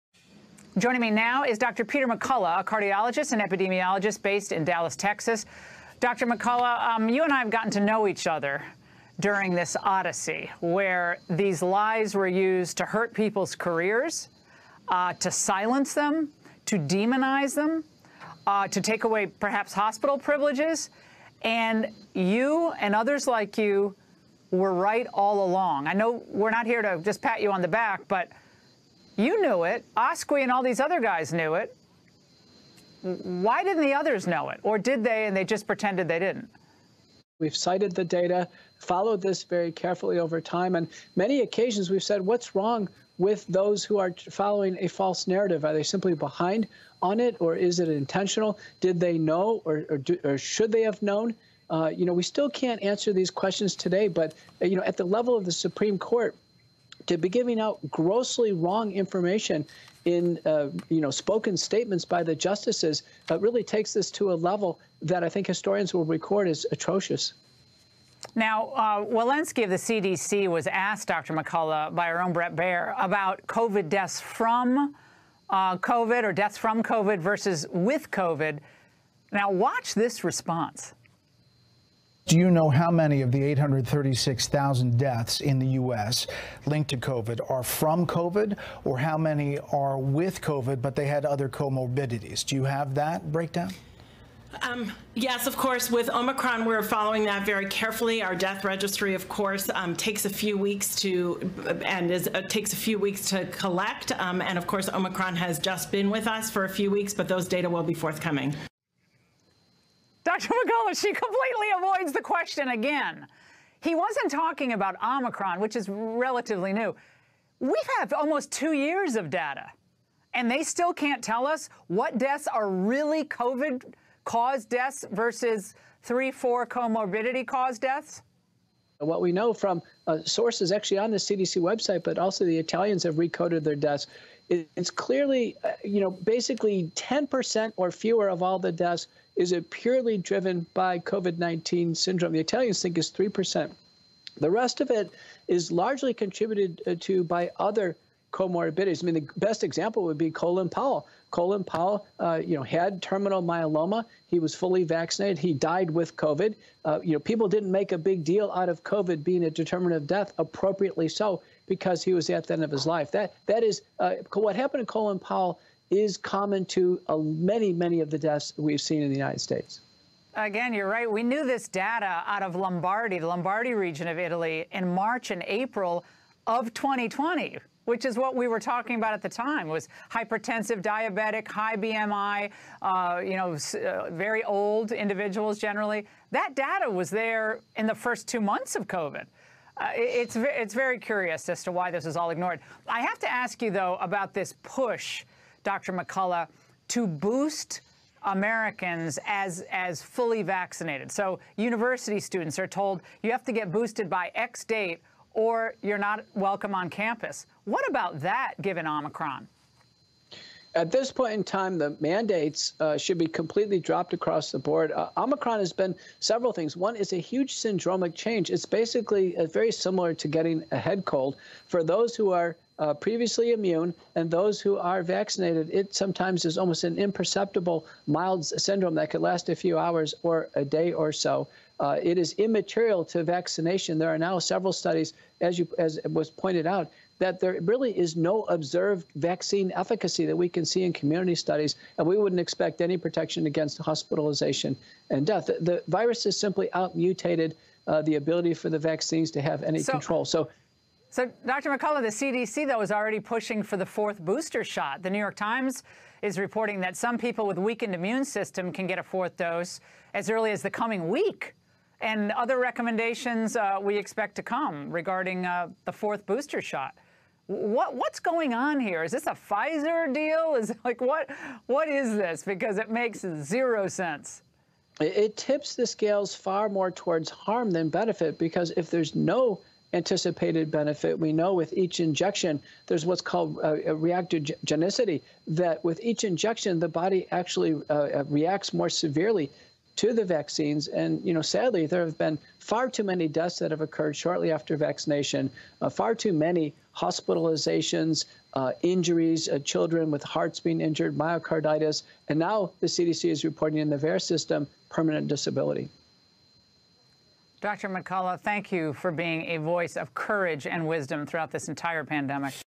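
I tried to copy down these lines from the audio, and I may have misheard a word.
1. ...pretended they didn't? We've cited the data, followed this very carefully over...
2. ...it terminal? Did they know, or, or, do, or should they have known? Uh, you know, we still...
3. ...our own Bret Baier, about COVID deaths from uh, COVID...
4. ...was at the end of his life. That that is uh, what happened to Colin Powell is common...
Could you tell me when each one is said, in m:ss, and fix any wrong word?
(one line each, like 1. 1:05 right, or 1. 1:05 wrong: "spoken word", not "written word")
1. 0:35 right
2. 0:47 wrong: "intentional", not "terminal"
3. 1:12 right
4. 2:42 right.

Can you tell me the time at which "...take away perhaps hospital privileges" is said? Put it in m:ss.
0:18.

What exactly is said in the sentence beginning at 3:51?
Uh, it is immaterial to vaccination.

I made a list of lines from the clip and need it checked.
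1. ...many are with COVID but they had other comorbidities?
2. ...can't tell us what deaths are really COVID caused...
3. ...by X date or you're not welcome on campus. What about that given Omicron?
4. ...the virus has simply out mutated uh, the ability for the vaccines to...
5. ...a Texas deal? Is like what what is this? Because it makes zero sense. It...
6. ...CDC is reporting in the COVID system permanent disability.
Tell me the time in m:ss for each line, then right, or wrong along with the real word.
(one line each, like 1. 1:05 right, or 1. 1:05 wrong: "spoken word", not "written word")
1. 1:29 right
2. 2:00 right
3. 3:24 right
4. 4:05 right
5. 4:29 wrong: "Pfizer", not "Texas"
6. 5:02 wrong: "VAERS", not "COVID".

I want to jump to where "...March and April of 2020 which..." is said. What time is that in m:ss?
2:54.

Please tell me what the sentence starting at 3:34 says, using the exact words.
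Uh, Omicron has been several things.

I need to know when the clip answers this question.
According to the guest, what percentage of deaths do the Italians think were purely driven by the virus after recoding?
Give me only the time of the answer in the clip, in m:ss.
2:23.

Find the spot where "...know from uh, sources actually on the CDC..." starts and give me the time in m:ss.
2:09.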